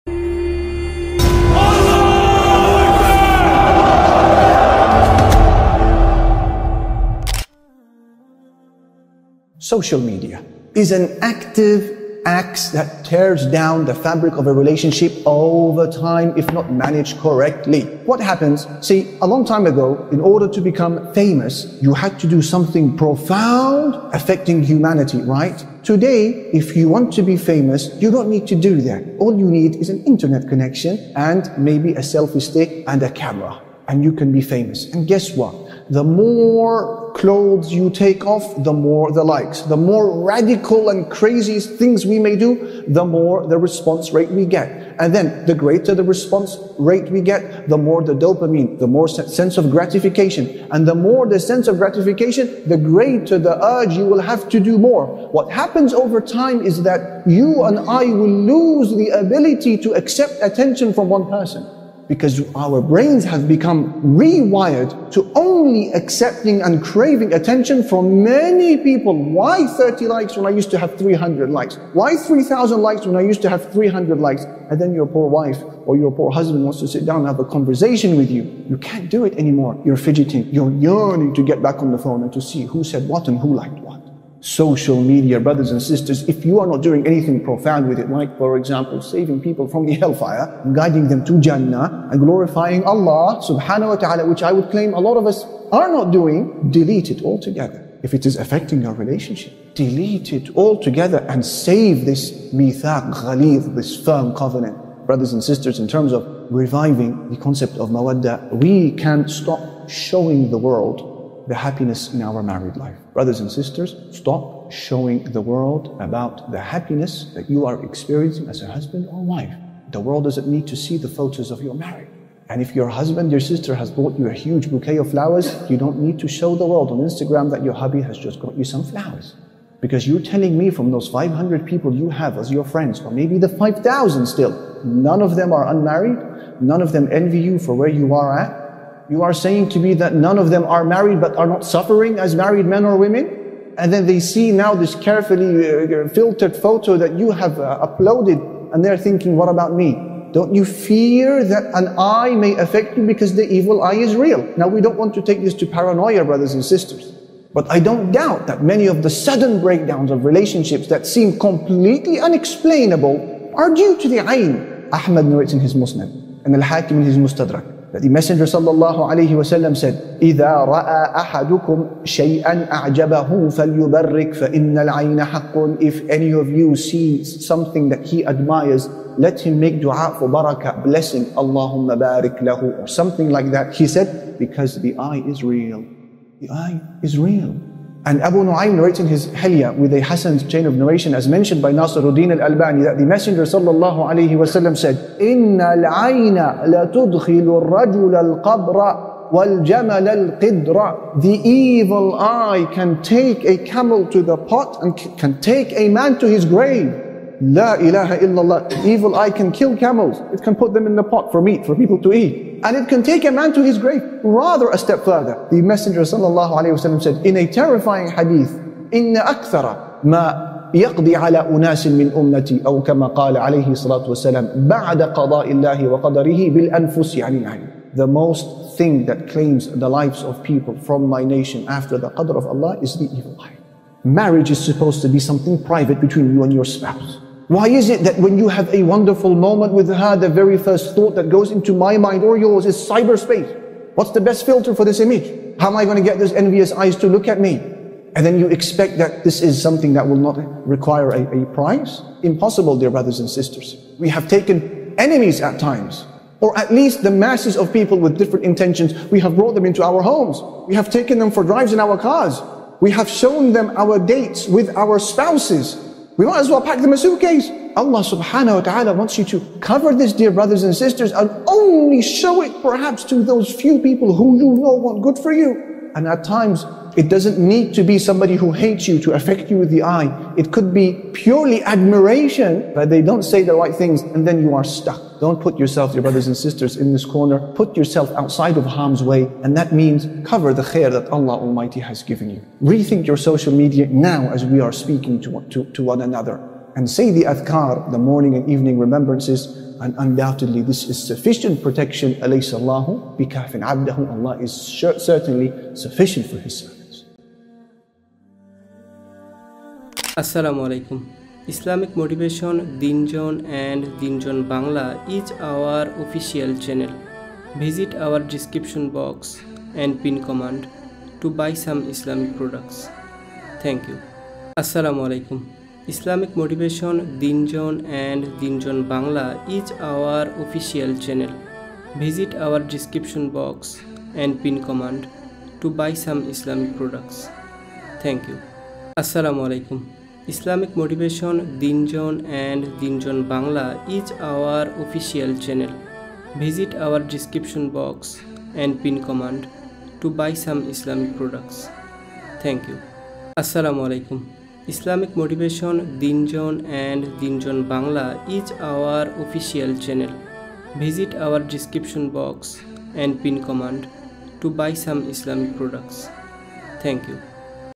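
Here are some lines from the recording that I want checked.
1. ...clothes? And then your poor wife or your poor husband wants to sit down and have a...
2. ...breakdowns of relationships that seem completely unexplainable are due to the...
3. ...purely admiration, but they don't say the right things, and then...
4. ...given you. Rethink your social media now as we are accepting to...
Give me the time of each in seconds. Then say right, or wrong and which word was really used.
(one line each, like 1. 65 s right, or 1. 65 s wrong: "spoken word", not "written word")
1. 74 s wrong: "likes", not "clothes"
2. 159 s right
3. 281 s right
4. 292 s wrong: "speaking", not "accepting".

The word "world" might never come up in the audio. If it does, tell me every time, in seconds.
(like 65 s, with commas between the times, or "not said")
110 s, 115 s, 119 s, 126 s.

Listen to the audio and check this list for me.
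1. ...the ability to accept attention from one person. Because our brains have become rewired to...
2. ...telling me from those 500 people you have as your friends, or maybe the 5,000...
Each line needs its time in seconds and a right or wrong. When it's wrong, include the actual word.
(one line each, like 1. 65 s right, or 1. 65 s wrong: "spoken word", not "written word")
1. 58 s right
2. 130 s right.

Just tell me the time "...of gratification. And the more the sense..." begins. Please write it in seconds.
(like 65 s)
49 s.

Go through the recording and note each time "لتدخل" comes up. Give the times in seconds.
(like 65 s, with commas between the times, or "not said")
196 s.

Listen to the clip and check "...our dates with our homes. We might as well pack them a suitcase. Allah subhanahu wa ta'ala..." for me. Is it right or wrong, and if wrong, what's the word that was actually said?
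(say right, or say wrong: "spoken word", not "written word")
wrong: "spouses", not "homes".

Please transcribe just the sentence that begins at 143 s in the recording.
And then they see now this carefully uh, uh, filtered photo that you have uh, uploaded and they're thinking, what about me?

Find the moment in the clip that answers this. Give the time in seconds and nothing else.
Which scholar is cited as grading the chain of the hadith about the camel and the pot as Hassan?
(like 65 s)
191 s.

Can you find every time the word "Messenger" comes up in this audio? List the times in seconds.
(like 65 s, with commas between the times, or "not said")
168 s, 193 s, 215 s.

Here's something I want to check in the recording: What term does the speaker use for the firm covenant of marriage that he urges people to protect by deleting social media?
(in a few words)
mithaq ghalid.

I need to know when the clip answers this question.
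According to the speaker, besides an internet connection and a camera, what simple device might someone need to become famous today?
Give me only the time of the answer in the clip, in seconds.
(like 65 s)
32 s.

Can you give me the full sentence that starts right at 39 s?
The more radical and crazy things we may do, the more the response rate we get.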